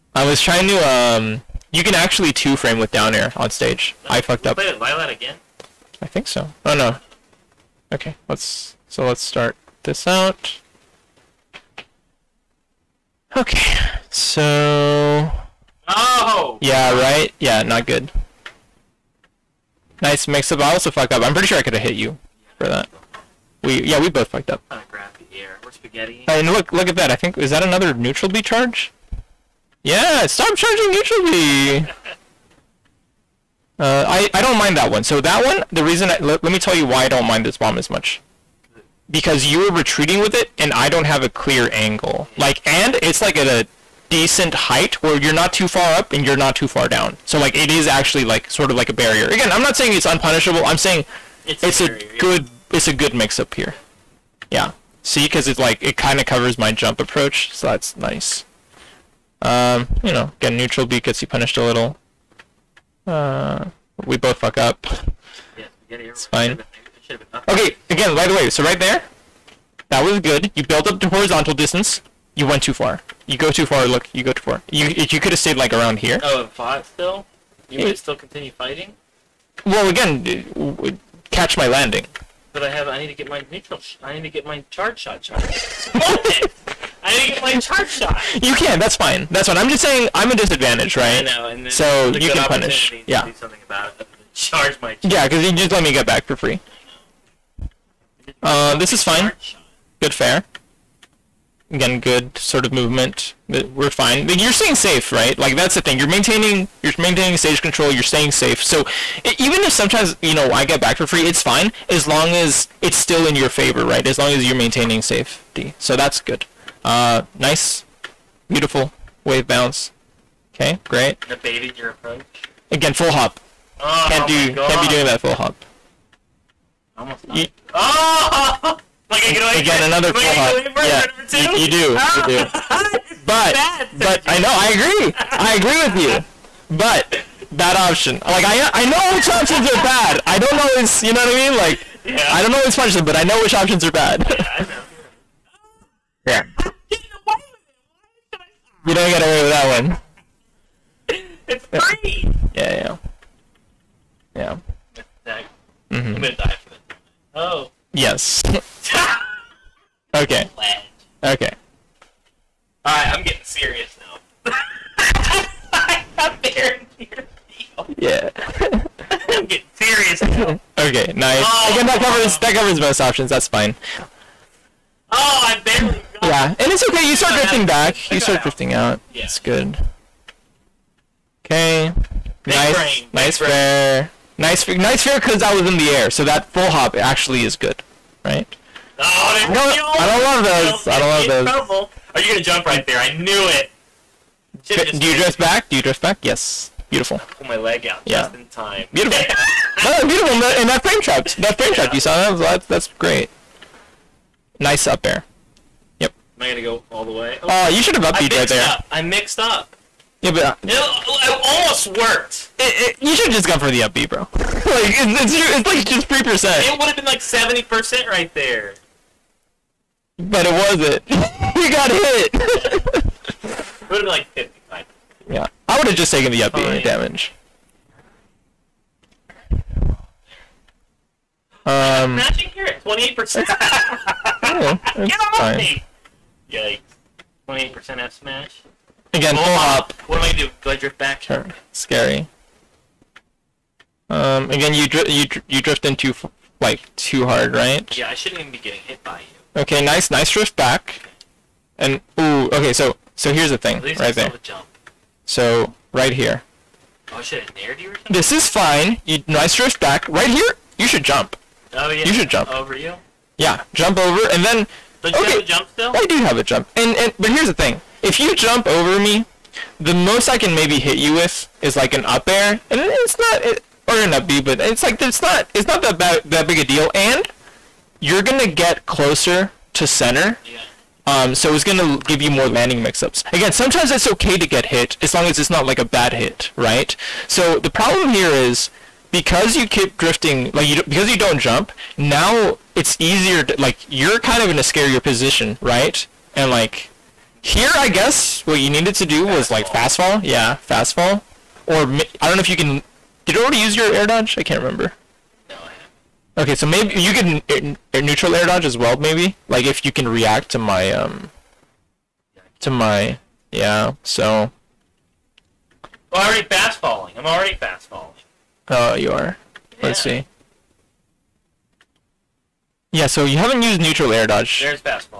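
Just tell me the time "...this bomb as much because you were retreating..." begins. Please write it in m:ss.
0:37.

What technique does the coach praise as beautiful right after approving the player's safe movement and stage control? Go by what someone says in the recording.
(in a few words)
wave bounce.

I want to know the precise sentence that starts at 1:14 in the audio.
You you could have stayed like around here.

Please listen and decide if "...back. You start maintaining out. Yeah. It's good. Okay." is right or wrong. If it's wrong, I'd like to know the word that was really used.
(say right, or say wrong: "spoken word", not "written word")
wrong: "drifting", not "maintaining".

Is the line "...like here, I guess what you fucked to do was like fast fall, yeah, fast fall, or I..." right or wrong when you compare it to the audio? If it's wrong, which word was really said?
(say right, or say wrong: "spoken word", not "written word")
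wrong: "needed", not "fucked".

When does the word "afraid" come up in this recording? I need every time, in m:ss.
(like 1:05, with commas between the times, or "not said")
not said.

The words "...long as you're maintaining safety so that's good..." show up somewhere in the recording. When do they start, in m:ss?
1:54.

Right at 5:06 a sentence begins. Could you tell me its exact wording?
Okay, so maybe you can neutral air dodge as well, maybe?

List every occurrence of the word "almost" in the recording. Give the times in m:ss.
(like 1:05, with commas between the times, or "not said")
2:06, 3:31.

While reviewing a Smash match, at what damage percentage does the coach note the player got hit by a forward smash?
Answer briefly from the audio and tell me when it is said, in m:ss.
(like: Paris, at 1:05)
28%, at 3:57.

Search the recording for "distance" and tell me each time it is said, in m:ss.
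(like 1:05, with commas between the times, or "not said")
1:11.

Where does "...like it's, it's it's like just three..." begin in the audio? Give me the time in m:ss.
3:34.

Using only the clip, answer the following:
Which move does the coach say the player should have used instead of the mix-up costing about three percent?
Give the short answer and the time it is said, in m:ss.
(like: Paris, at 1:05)
up B, at 3:28.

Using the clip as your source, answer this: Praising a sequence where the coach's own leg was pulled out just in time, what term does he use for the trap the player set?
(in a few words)
frame trap.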